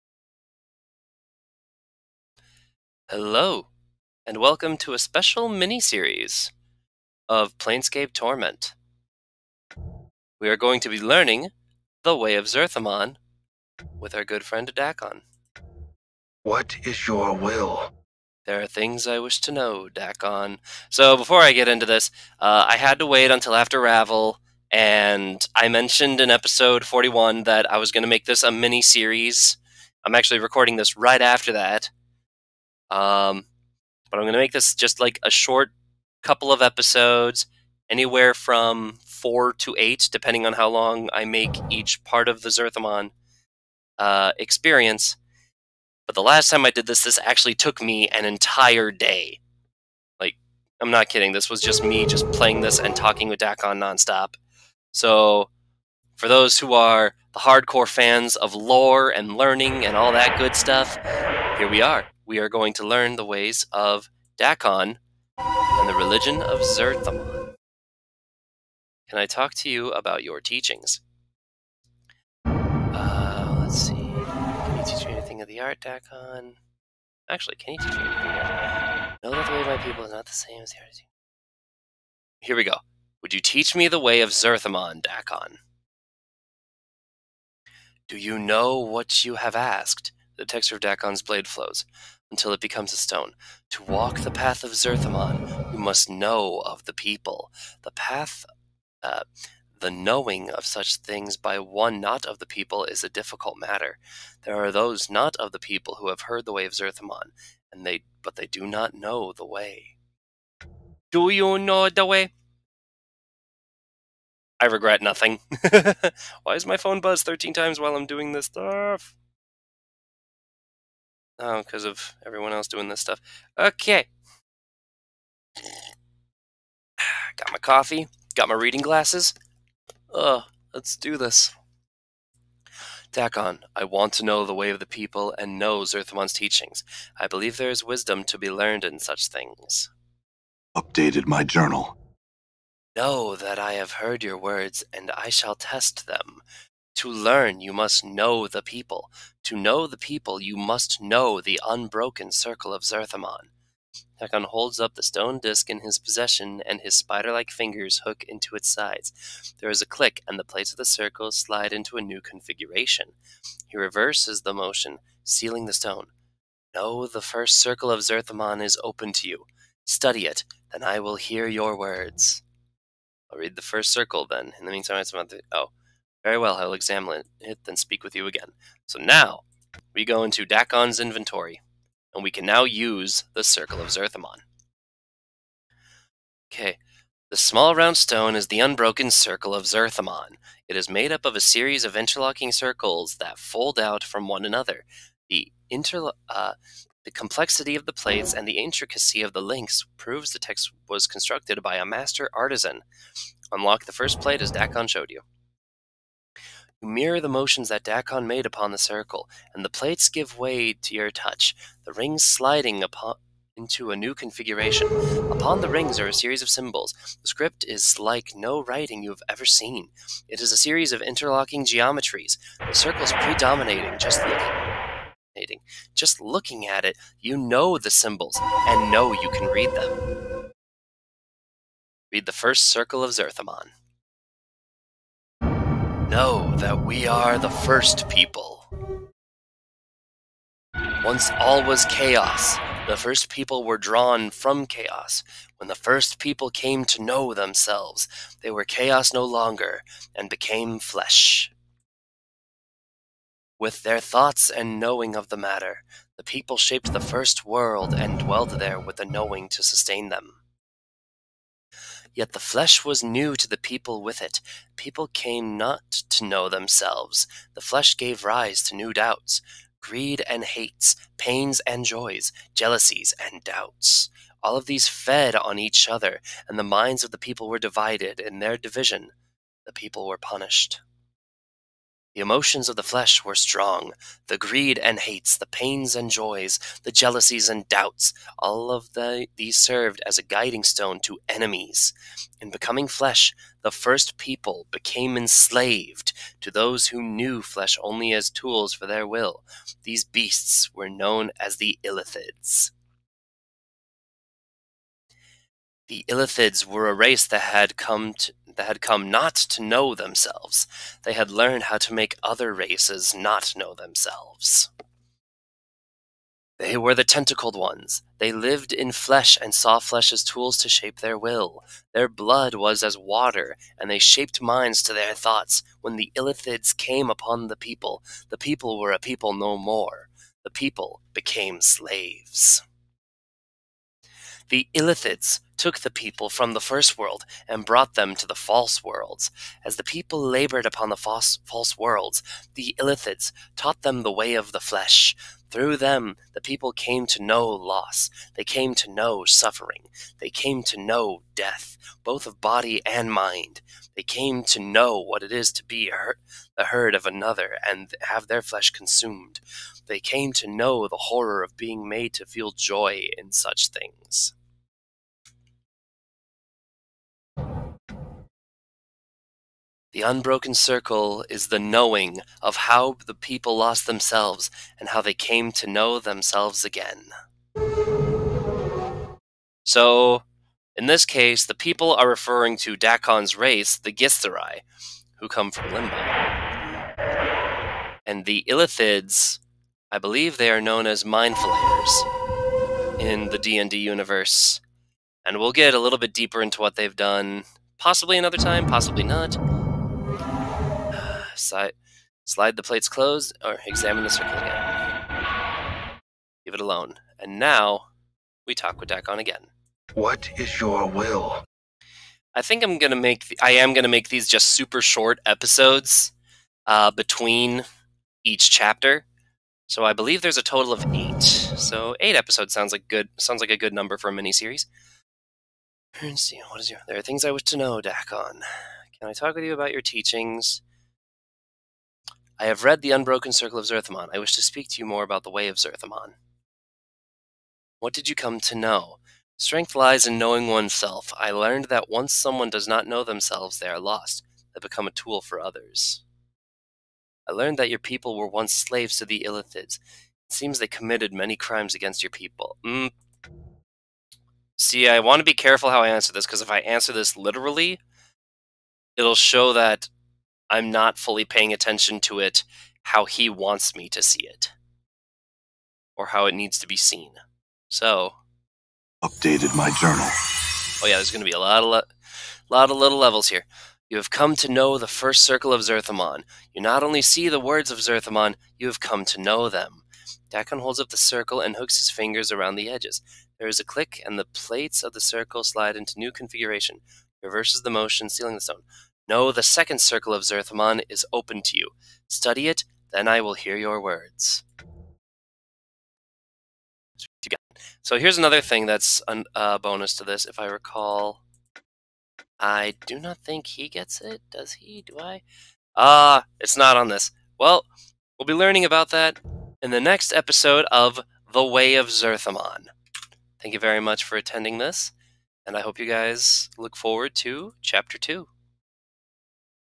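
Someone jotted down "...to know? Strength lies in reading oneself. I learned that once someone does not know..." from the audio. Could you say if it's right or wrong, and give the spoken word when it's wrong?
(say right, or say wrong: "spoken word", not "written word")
wrong: "knowing", not "reading".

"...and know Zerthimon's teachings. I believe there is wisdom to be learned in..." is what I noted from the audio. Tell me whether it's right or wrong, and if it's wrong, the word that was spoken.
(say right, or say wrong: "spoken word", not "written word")
right.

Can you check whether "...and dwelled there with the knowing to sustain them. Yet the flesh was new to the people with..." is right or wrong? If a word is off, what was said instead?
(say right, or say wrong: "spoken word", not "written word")
right.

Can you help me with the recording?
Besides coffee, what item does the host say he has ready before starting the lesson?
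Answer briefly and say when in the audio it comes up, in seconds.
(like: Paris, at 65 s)
Reading glasses, at 128 s.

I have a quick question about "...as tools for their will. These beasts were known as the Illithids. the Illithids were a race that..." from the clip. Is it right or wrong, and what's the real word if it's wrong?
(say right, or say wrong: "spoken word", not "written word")
right.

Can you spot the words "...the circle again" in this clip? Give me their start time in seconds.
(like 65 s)
404 s.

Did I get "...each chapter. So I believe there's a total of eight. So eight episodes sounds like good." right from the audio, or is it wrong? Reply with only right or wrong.
right.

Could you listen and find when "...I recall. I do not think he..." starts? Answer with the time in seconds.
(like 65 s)
500 s.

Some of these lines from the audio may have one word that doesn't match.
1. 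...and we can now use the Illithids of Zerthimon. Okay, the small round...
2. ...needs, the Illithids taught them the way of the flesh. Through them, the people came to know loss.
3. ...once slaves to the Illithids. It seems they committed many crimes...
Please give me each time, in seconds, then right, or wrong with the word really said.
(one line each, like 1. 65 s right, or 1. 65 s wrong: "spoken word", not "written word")
1. 182 s wrong: "Circle", not "Illithids"
2. 341 s wrong: "worlds", not "needs"
3. 448 s right.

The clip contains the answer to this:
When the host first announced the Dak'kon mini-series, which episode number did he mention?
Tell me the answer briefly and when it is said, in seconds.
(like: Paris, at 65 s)
41, at 26 s.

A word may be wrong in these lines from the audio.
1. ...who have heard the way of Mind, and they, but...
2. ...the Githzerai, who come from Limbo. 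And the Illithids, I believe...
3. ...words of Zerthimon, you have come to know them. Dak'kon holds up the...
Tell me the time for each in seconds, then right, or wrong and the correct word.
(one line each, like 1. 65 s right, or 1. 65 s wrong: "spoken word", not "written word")
1. 105 s wrong: "Zerthimon", not "Mind"
2. 383 s right
3. 477 s right.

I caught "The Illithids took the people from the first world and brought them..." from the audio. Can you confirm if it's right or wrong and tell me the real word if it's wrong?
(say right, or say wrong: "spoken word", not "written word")
right.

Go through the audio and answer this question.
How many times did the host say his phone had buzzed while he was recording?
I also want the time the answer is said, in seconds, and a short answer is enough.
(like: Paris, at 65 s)
13, at 117 s.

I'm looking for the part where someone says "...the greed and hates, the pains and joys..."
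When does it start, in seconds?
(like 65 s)
284 s.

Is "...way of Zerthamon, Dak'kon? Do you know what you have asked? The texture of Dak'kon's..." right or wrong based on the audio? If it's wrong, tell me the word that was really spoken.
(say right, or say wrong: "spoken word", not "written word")
right.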